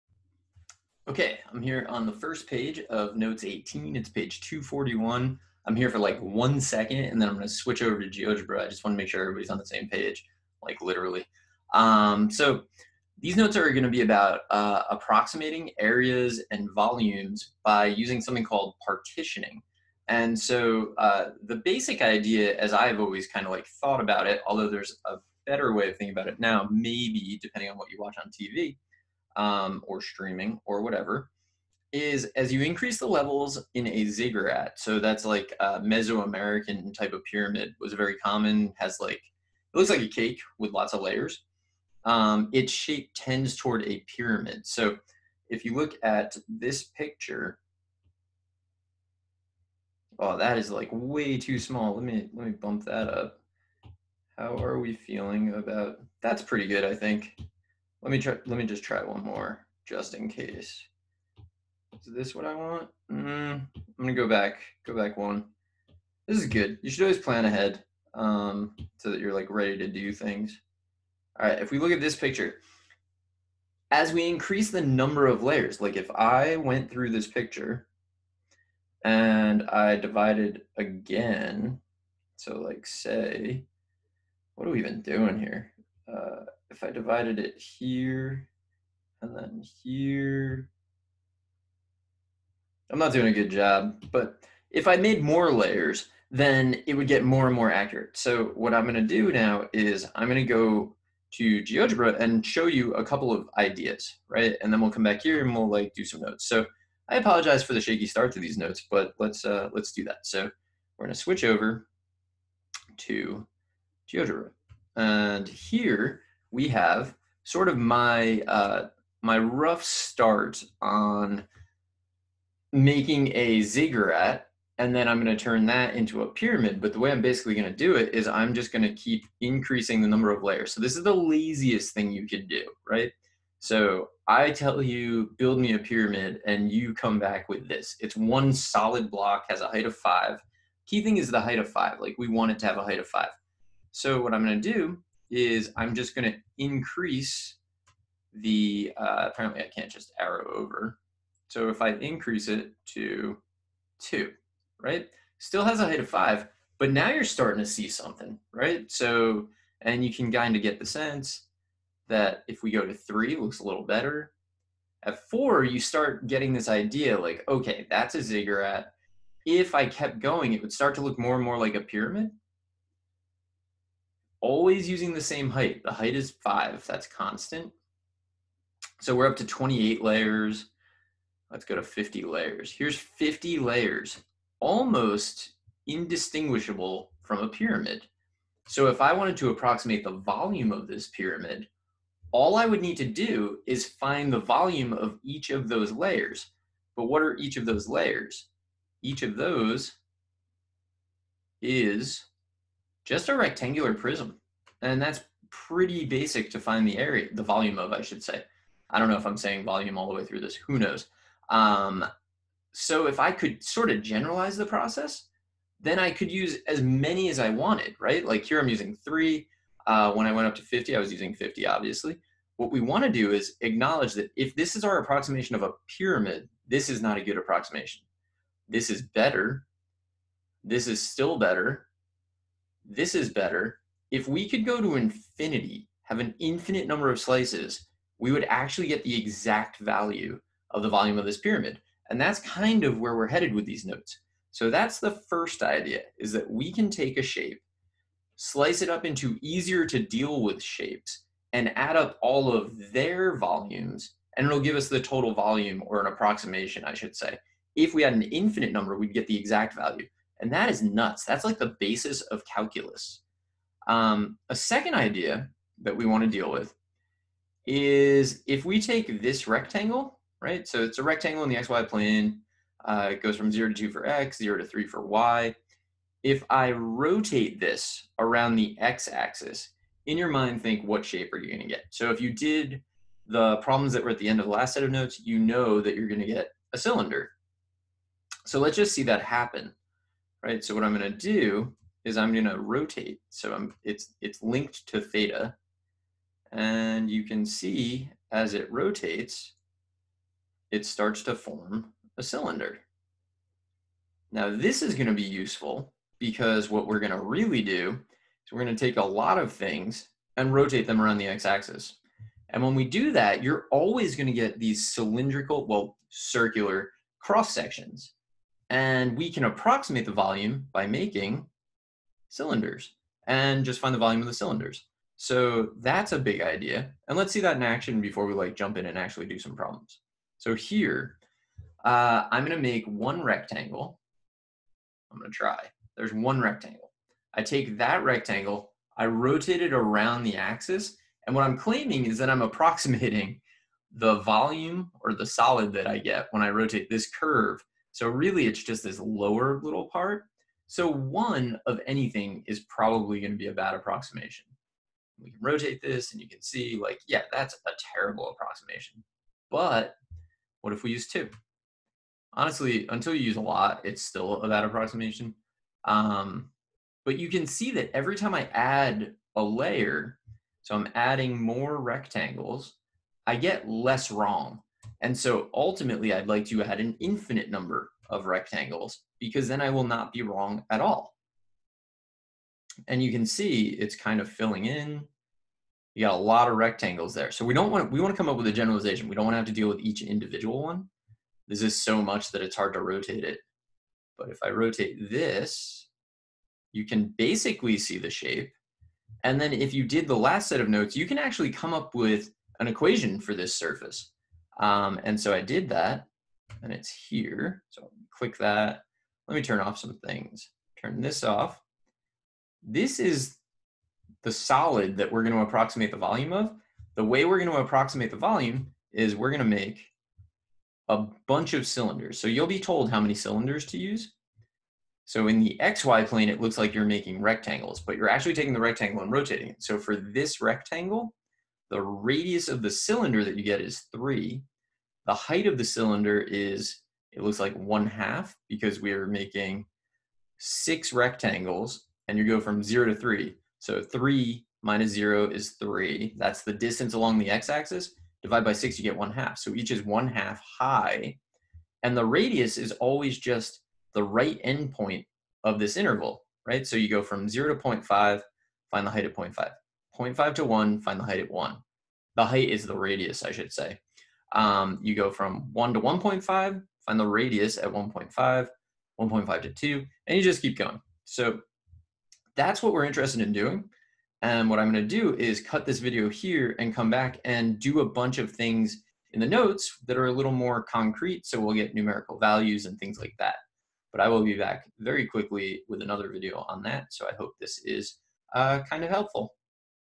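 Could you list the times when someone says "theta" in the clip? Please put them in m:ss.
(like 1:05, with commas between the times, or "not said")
4:55.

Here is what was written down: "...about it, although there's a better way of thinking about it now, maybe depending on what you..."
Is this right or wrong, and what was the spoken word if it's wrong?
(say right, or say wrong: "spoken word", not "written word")
right.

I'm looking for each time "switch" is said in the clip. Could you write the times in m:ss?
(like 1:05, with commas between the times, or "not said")
0:07, 1:51.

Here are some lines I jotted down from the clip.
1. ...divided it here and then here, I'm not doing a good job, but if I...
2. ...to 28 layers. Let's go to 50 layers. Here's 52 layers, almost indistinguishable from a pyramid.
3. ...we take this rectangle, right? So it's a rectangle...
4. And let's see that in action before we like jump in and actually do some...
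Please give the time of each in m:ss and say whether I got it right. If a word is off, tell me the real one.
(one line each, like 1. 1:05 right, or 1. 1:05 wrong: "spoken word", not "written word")
1. 1:26 right
2. 2:59 wrong: "50", not "52"
3. 4:28 right
4. 5:27 right.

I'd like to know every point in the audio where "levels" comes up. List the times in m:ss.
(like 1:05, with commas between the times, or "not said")
0:33.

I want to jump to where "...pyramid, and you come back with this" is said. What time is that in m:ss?
2:15.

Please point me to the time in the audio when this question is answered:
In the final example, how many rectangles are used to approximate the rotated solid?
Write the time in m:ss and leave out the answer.
7:20.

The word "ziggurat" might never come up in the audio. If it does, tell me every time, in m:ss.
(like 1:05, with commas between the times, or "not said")
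0:34, 2:03, 2:48.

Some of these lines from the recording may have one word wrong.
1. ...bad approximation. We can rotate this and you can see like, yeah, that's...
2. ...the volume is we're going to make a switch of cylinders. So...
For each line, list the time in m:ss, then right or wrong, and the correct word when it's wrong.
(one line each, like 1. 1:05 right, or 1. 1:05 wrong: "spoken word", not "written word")
1. 5:53 right
2. 6:58 wrong: "bunch", not "switch".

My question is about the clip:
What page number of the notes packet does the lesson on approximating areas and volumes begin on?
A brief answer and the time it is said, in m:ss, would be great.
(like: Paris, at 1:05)
241, at 0:04.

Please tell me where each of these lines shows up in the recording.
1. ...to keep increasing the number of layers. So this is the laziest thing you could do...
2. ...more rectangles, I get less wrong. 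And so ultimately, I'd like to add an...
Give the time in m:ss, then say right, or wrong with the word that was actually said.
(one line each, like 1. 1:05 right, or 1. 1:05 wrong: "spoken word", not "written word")
1. 2:08 right
2. 6:11 right.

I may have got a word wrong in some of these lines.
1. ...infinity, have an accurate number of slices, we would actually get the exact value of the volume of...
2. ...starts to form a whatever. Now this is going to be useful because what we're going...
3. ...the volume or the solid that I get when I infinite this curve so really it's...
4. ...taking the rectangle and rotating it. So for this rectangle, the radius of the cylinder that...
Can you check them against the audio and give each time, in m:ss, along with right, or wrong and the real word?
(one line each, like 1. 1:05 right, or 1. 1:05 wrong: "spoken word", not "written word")
1. 3:54 wrong: "infinite", not "accurate"
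2. 5:00 wrong: "cylinder", not "whatever"
3. 5:43 wrong: "rotate", not "infinite"
4. 7:08 right.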